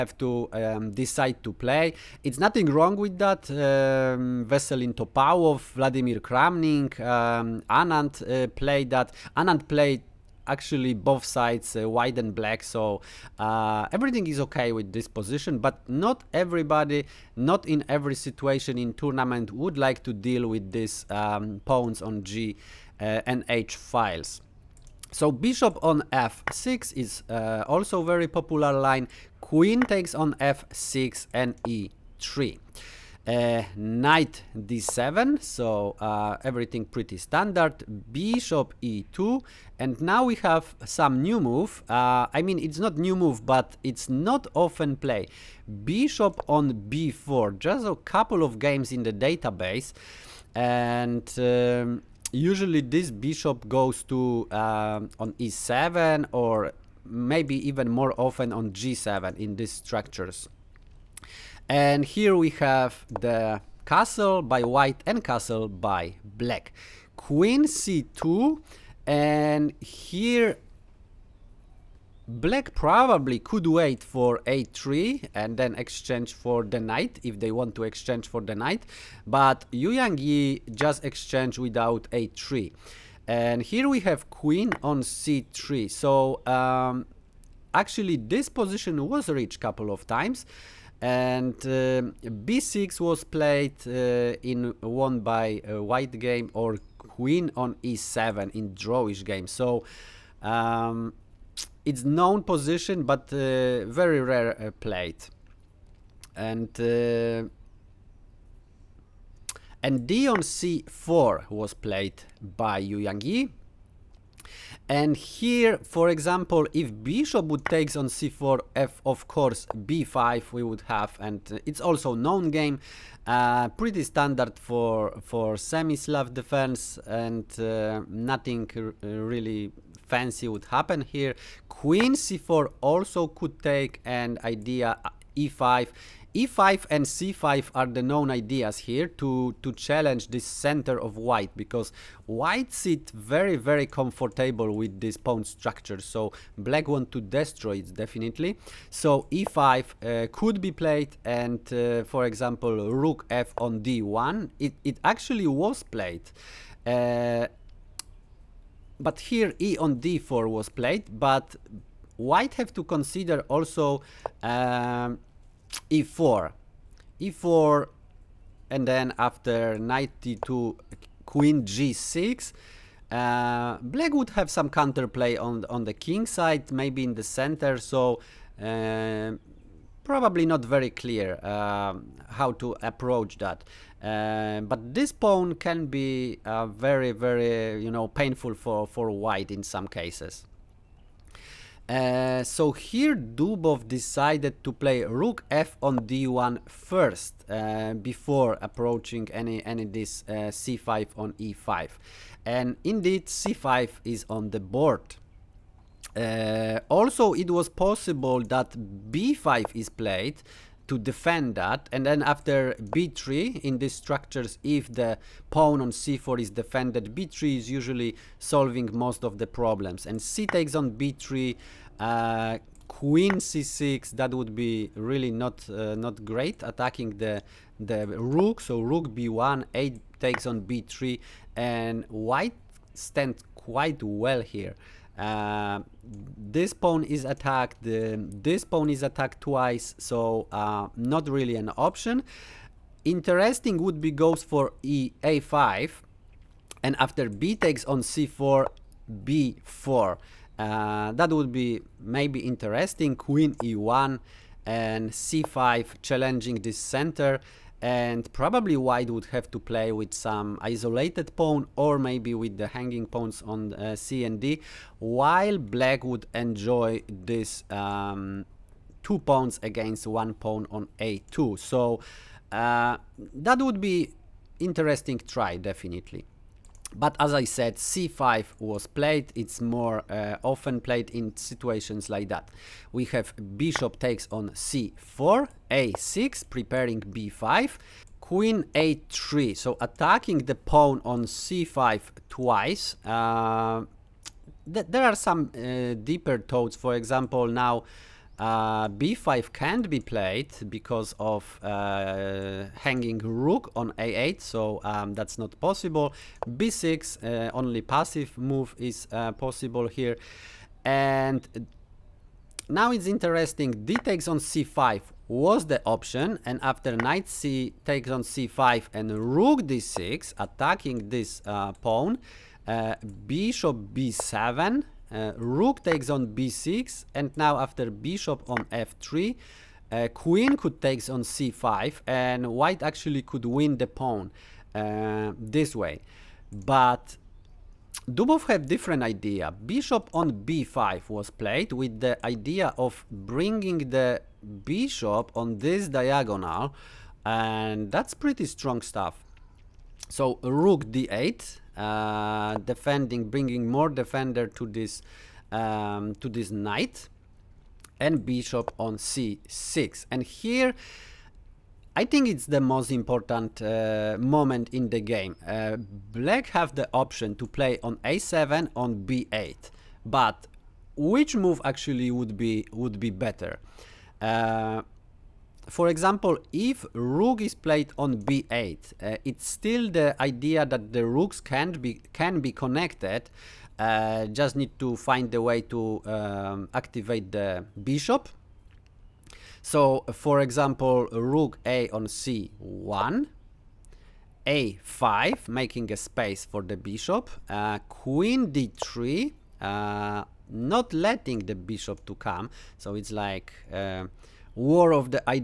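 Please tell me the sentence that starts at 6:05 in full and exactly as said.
Uh, black have the option to play on a7 on b8, but which move actually would be would be better?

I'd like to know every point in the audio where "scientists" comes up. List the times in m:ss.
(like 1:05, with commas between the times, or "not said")
not said.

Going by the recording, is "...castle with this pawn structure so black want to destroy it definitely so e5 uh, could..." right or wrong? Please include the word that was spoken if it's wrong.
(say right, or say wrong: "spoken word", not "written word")
wrong: "comfortable", not "castle".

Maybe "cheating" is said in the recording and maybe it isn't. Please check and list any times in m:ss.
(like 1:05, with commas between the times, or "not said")
not said.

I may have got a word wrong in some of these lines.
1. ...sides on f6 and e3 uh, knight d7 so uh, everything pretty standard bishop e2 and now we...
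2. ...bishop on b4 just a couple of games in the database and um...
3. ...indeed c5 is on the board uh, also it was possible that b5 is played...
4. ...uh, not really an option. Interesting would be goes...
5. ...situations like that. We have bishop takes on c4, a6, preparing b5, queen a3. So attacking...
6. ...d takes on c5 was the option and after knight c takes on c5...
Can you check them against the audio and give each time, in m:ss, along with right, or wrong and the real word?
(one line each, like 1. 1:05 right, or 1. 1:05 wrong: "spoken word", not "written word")
1. 0:29 wrong: "takes", not "sides"
2. 0:45 right
3. 3:22 right
4. 4:00 right
5. 4:41 right
6. 5:13 right.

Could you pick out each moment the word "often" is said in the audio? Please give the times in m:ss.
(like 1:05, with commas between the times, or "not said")
0:44, 0:58, 4:40.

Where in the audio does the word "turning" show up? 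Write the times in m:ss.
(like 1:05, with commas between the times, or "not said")
not said.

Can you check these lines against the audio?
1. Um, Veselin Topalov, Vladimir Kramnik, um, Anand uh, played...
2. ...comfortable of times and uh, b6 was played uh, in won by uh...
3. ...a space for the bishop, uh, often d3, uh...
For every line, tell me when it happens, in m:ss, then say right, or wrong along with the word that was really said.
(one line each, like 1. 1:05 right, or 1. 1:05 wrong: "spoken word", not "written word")
1. 0:03 right
2. 1:29 wrong: "couple", not "comfortable"
3. 6:35 wrong: "queen", not "often".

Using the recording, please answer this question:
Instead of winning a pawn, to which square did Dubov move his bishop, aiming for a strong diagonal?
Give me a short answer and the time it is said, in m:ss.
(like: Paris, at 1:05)
b5, at 5:39.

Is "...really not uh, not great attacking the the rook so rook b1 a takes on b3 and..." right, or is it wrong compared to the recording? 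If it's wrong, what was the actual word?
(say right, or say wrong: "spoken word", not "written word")
right.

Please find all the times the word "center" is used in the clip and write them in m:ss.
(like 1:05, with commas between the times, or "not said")
2:20, 2:57, 4:16.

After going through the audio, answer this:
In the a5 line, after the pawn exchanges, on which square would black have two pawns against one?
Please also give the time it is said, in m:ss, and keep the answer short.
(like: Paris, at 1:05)
A2, at 4:30.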